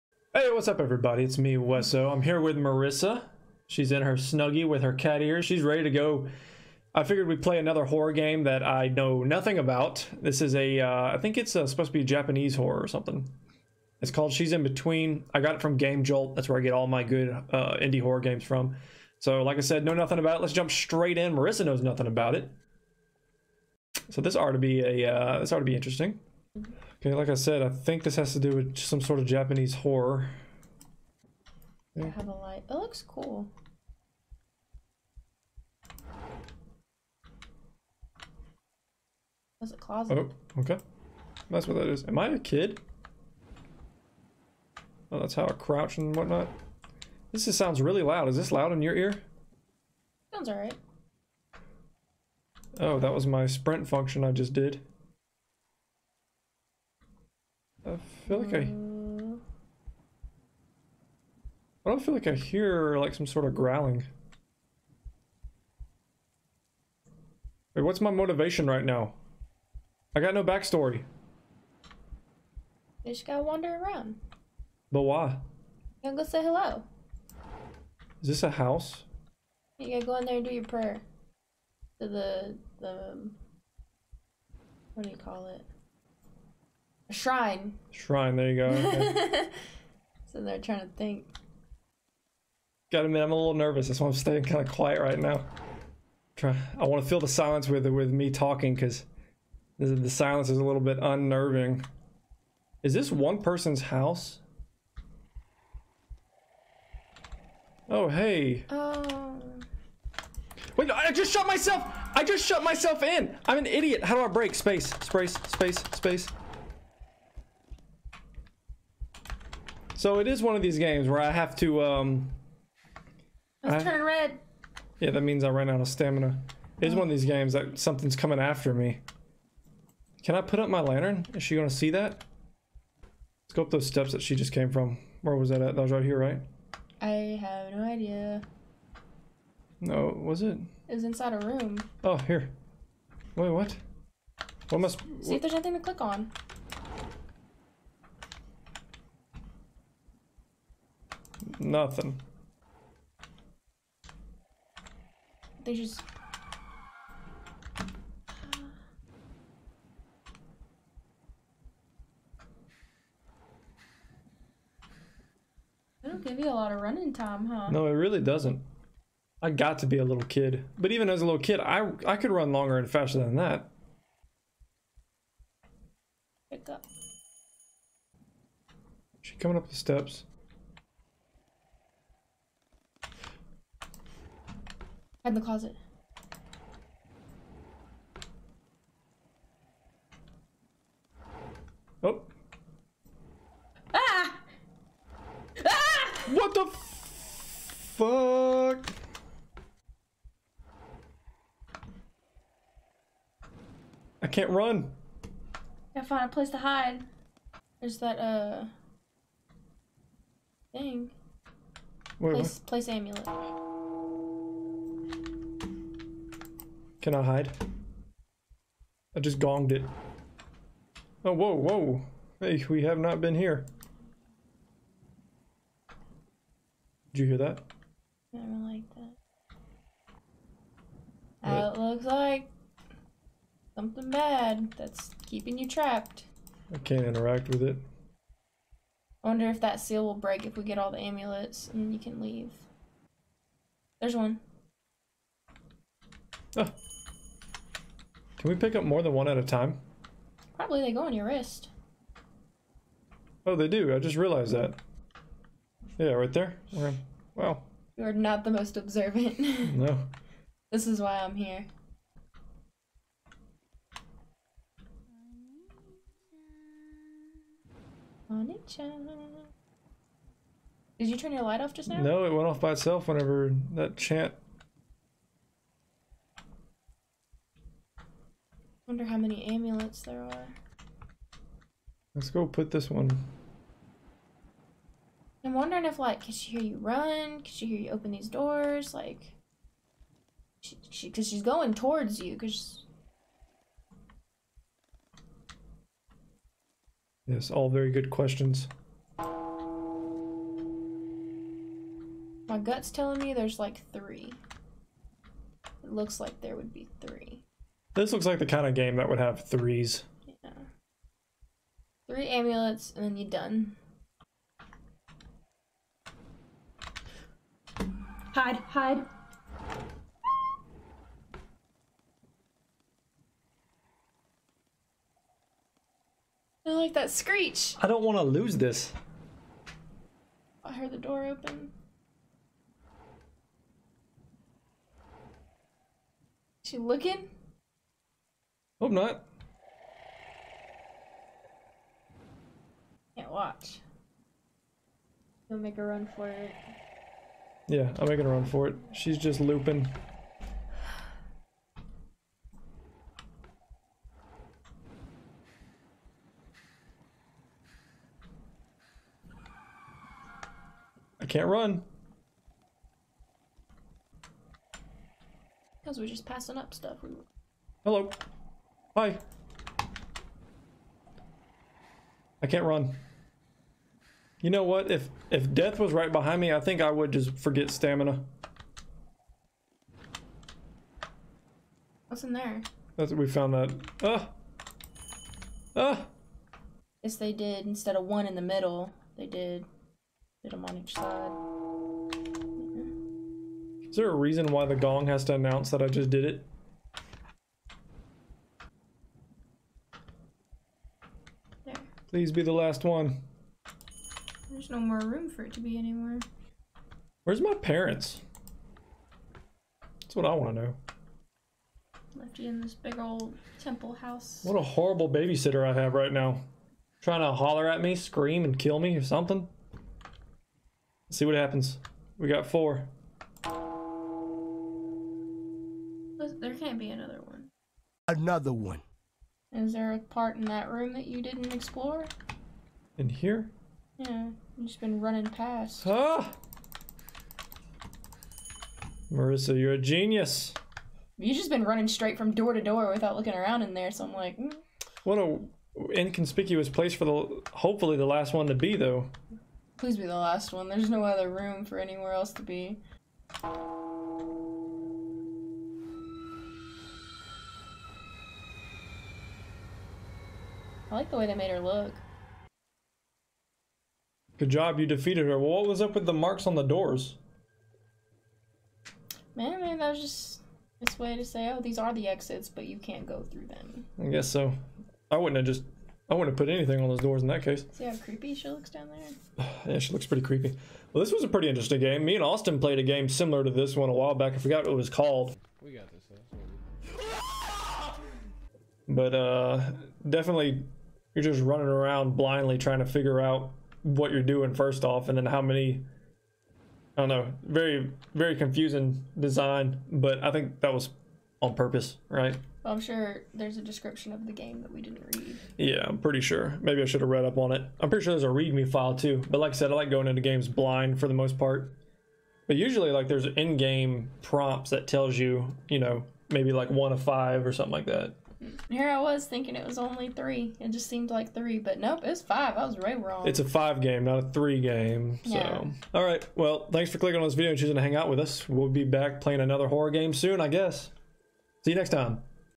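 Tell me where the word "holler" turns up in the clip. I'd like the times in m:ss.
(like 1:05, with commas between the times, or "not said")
6:57.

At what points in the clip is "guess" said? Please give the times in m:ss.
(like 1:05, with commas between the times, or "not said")
7:54, 8:50.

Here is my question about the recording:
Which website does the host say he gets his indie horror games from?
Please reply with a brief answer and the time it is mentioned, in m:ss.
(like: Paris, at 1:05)
Game Jolt, at 0:15.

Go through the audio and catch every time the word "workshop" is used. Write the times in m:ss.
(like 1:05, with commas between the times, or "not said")
not said.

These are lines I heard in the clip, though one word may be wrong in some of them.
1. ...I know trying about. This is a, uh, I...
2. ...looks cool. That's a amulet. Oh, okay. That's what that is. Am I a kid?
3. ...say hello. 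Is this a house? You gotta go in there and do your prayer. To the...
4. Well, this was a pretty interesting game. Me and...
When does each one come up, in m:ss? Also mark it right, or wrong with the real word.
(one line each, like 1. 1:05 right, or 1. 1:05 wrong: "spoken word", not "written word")
1. 0:08 wrong: "nothing", not "trying"
2. 0:32 wrong: "closet", not "amulet"
3. 1:16 right
4. 8:00 right.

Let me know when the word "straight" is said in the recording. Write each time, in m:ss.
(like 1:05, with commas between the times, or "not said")
0:20, 7:21.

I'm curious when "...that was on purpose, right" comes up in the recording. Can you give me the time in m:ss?
8:20.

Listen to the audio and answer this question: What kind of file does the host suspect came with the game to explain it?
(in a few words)
README file.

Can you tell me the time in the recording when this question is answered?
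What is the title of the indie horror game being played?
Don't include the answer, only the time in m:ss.
0:14.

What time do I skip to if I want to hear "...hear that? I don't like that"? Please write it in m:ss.
3:47.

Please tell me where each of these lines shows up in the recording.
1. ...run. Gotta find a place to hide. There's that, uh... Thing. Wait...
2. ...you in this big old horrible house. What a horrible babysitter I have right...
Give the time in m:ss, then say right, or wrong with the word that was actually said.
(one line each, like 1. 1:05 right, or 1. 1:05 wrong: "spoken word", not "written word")
1. 3:24 right
2. 6:52 wrong: "temple", not "horrible".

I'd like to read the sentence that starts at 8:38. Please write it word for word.
Here I was thinking it was only three.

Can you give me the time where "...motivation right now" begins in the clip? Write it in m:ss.
1:08.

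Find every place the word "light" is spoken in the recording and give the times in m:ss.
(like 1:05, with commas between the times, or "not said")
0:32, 4:31.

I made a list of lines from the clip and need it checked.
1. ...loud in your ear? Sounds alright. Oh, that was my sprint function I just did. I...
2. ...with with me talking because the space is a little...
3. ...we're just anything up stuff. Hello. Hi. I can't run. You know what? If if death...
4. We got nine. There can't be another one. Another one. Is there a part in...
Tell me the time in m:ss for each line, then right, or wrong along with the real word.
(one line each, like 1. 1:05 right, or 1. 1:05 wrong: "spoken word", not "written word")
1. 0:48 right
2. 1:37 wrong: "silence", not "space"
3. 6:05 wrong: "passing", not "anything"
4. 7:02 wrong: "four", not "nine".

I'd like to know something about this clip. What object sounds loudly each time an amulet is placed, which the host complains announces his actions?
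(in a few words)
gong.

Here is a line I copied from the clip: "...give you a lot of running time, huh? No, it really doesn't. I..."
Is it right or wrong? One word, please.
right.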